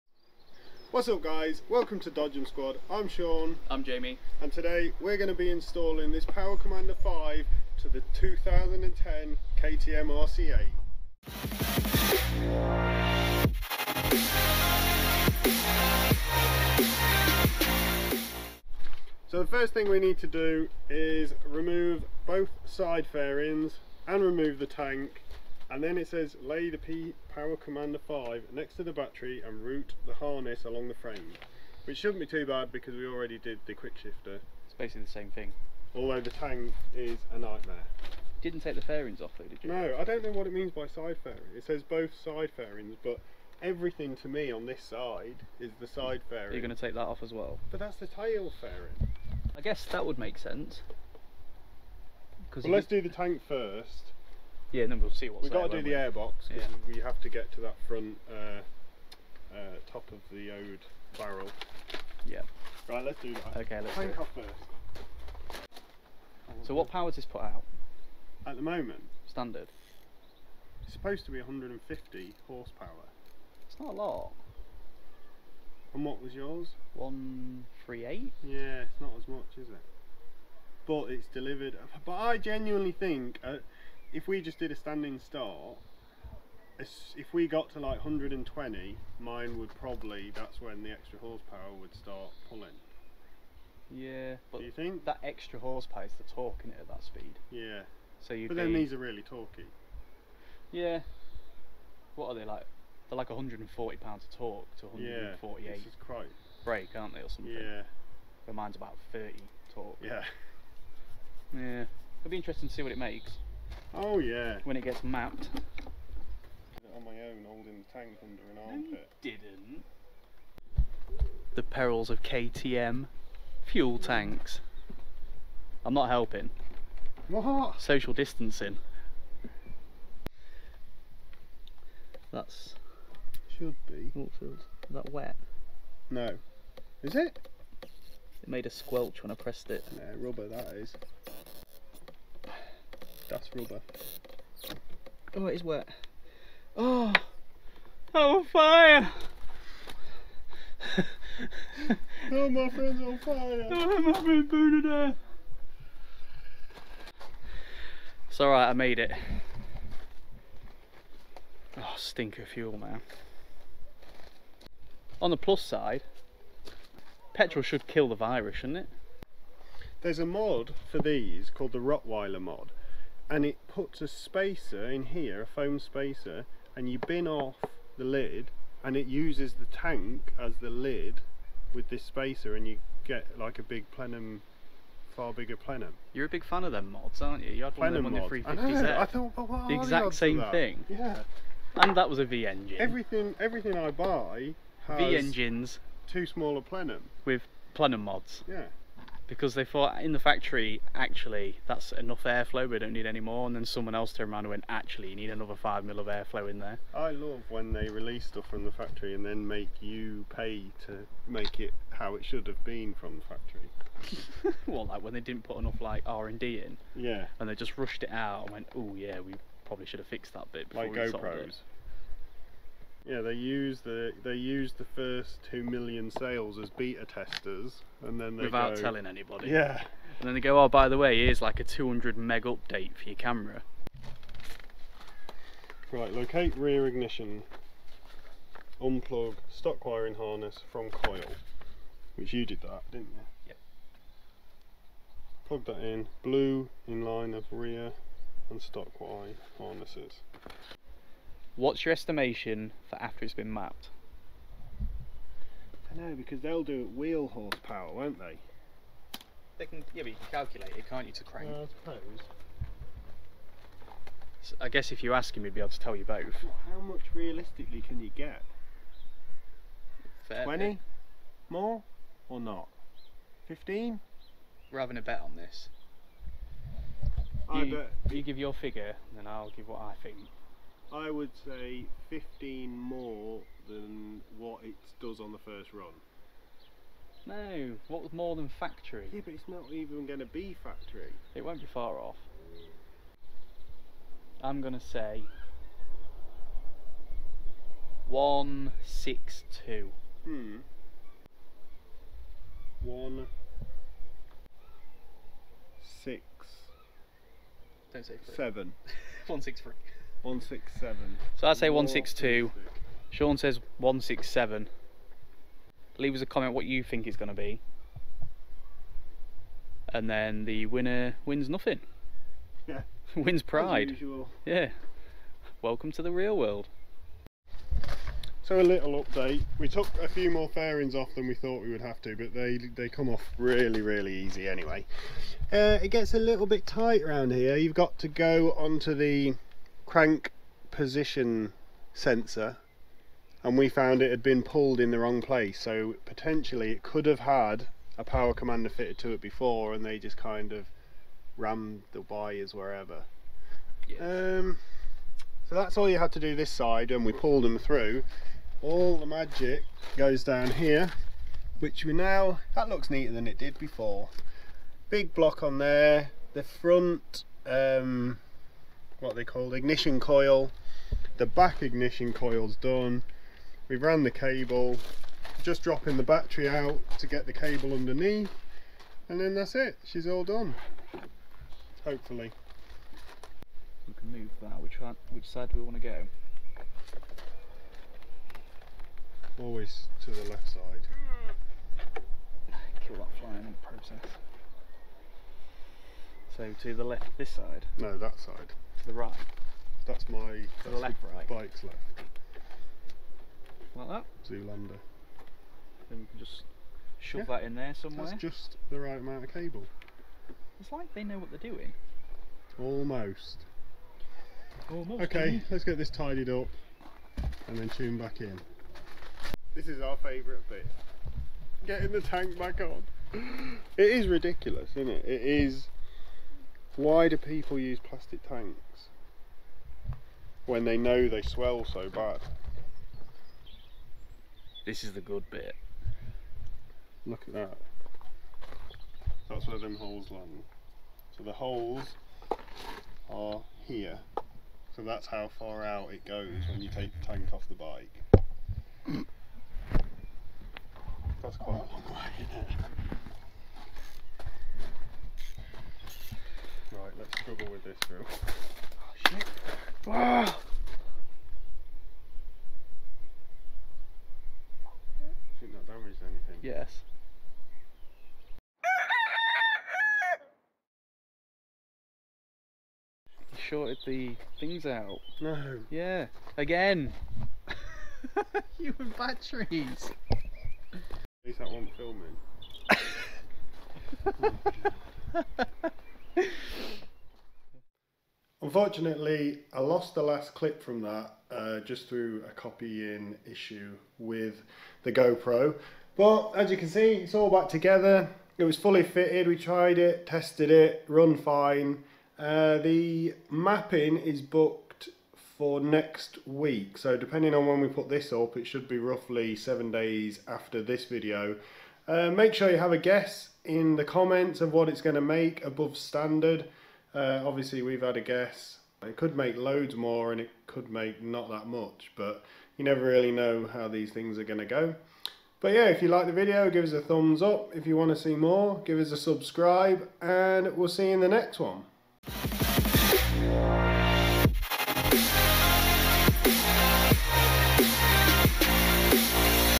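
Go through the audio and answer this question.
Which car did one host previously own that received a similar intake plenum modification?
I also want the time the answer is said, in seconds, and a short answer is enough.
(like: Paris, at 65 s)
350Z, at 188 s.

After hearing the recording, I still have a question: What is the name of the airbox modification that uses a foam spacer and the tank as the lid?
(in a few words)
Rottweiler mod.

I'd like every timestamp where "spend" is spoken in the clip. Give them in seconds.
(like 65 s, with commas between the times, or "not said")
not said.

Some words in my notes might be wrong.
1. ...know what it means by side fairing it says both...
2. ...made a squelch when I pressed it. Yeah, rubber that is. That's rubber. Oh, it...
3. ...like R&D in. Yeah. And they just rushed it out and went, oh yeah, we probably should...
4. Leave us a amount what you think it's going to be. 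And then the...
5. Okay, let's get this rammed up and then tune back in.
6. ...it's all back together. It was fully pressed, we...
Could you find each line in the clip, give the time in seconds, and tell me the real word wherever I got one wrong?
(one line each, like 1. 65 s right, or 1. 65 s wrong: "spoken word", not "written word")
1. 40 s right
2. 138 s right
3. 215 s right
4. 315 s wrong: "comment", not "amount"
5. 415 s wrong: "tidied", not "rammed"
6. 496 s wrong: "fitted", not "pressed".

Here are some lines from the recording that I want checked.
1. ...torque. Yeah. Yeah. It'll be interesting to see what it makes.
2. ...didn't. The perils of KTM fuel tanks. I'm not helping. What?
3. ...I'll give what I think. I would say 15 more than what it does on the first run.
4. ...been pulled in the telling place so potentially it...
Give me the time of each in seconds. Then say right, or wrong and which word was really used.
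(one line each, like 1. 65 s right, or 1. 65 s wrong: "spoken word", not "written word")
1. 109 s right
2. 119 s right
3. 279 s right
4. 344 s wrong: "wrong", not "telling".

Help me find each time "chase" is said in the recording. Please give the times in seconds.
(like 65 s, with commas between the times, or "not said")
not said.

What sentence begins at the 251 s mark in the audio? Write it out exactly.
What's your estimation for after it's been mapped?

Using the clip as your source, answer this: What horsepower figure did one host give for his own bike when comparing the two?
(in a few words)
138.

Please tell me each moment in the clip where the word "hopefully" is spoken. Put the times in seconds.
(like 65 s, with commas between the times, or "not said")
381 s.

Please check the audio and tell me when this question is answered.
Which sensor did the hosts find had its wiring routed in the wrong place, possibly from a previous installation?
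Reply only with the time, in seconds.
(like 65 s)
339 s.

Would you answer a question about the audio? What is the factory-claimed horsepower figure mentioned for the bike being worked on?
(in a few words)
150.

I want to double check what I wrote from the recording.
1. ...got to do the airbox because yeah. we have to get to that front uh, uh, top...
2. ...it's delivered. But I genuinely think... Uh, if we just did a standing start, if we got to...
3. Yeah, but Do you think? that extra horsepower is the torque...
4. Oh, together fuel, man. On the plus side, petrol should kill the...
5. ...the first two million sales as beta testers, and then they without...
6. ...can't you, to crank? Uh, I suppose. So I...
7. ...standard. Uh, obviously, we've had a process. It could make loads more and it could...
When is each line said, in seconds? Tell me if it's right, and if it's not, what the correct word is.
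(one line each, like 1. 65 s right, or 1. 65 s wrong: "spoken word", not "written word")
1. 55 s right
2. 81 s right
3. 93 s right
4. 161 s wrong: "stinker", not "together"
5. 224 s right
6. 260 s right
7. 515 s wrong: "guess", not "process".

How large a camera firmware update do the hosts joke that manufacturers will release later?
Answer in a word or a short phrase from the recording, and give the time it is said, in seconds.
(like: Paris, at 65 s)
200 meg, at 231 s.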